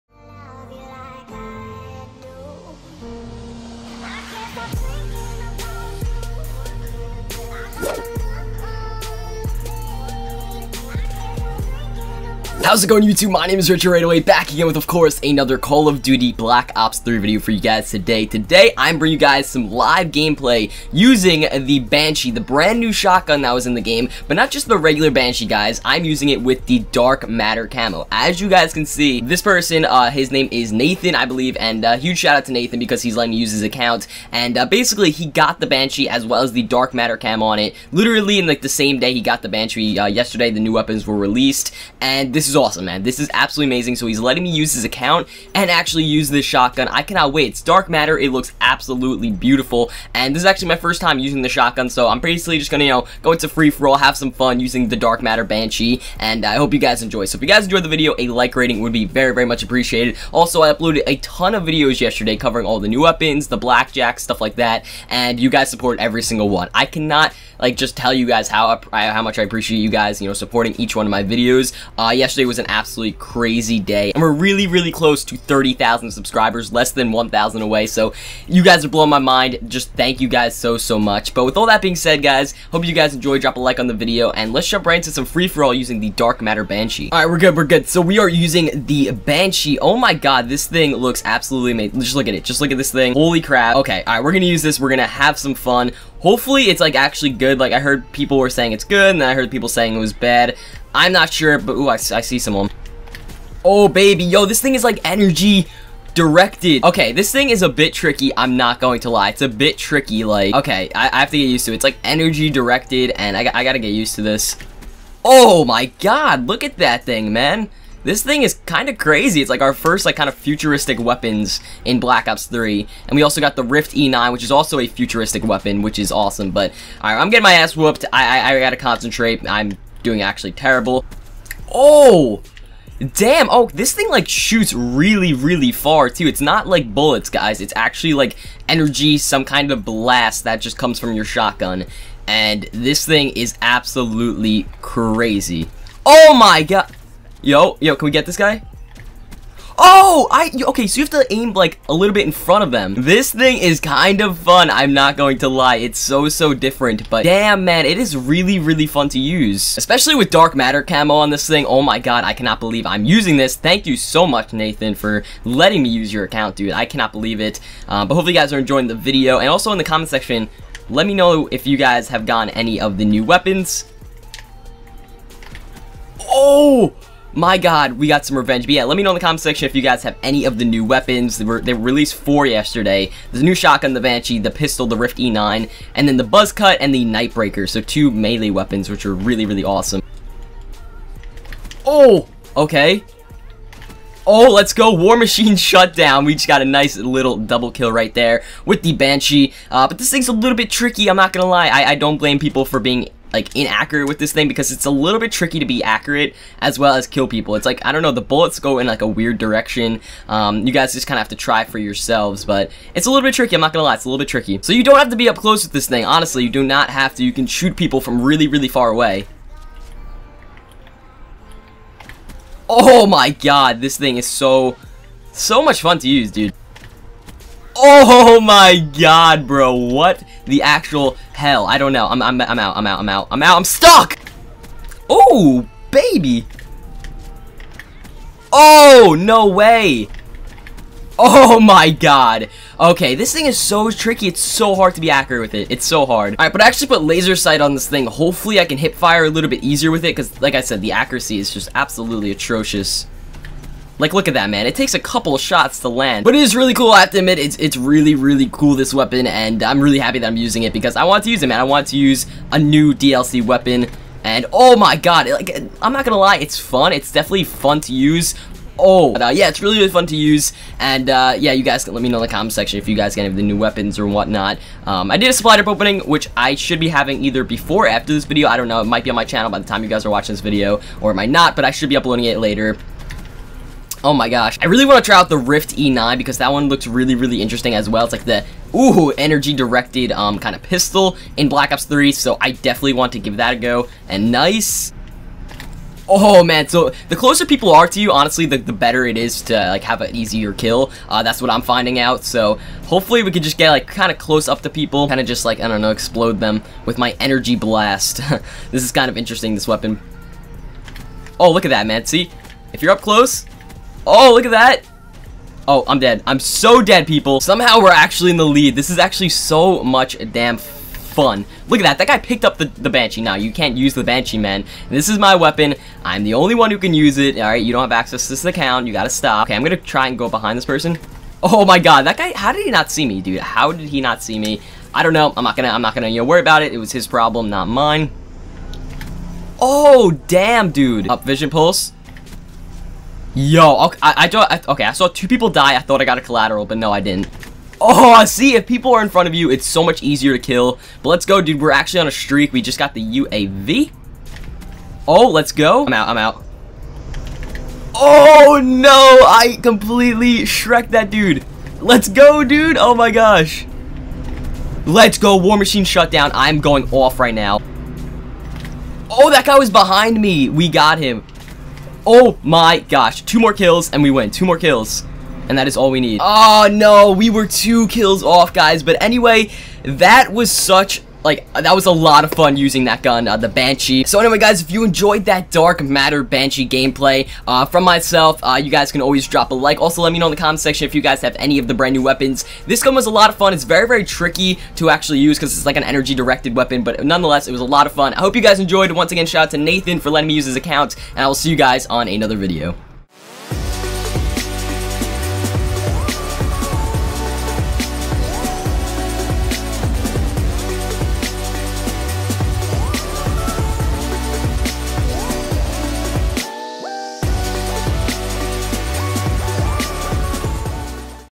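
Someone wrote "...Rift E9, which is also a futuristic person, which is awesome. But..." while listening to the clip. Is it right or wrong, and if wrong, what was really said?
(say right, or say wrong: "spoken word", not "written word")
wrong: "weapon", not "person".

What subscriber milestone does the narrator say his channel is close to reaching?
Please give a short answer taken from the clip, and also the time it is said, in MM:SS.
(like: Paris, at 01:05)
30,000, at 01:15.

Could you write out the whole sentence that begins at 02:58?
But yeah, let me know in the comment section if you guys have any of the new weapons.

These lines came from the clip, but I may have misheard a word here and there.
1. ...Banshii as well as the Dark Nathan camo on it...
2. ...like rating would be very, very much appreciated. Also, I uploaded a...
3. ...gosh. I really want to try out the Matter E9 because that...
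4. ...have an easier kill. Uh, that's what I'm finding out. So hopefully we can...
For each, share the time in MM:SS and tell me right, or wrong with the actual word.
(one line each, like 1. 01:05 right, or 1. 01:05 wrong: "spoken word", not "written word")
1. 00:35 wrong: "Matter", not "Nathan"
2. 00:58 right
3. 04:44 wrong: "Rift", not "Matter"
4. 04:59 right.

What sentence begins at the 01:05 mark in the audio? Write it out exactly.
And you guys support every single one.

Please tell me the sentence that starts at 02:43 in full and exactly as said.
Thank you so much, Nathan, for letting me use your account, dude.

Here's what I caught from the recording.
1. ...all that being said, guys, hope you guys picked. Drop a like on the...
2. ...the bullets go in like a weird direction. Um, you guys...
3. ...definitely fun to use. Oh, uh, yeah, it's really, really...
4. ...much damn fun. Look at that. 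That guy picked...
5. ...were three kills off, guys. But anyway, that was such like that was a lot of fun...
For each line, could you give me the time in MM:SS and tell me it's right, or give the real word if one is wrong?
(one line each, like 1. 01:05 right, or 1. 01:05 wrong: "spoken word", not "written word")
1. 01:21 wrong: "enjoyed", not "picked"
2. 03:28 right
3. 04:27 right
4. 05:19 right
5. 06:17 wrong: "two", not "three".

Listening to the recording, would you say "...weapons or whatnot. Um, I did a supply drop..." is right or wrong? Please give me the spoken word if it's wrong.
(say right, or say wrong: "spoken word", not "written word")
right.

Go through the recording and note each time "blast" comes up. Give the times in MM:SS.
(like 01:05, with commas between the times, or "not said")
02:19, 05:07.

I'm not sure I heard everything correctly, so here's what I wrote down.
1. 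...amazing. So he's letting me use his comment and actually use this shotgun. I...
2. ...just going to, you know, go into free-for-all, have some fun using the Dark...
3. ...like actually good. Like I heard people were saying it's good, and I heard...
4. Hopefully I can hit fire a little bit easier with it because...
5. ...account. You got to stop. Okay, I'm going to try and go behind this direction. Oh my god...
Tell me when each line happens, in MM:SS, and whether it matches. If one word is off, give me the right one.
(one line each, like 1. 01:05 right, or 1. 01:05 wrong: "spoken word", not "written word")
1. 00:43 wrong: "account", not "comment"
2. 00:52 right
3. 01:36 right
4. 04:08 right
5. 05:28 wrong: "person", not "direction".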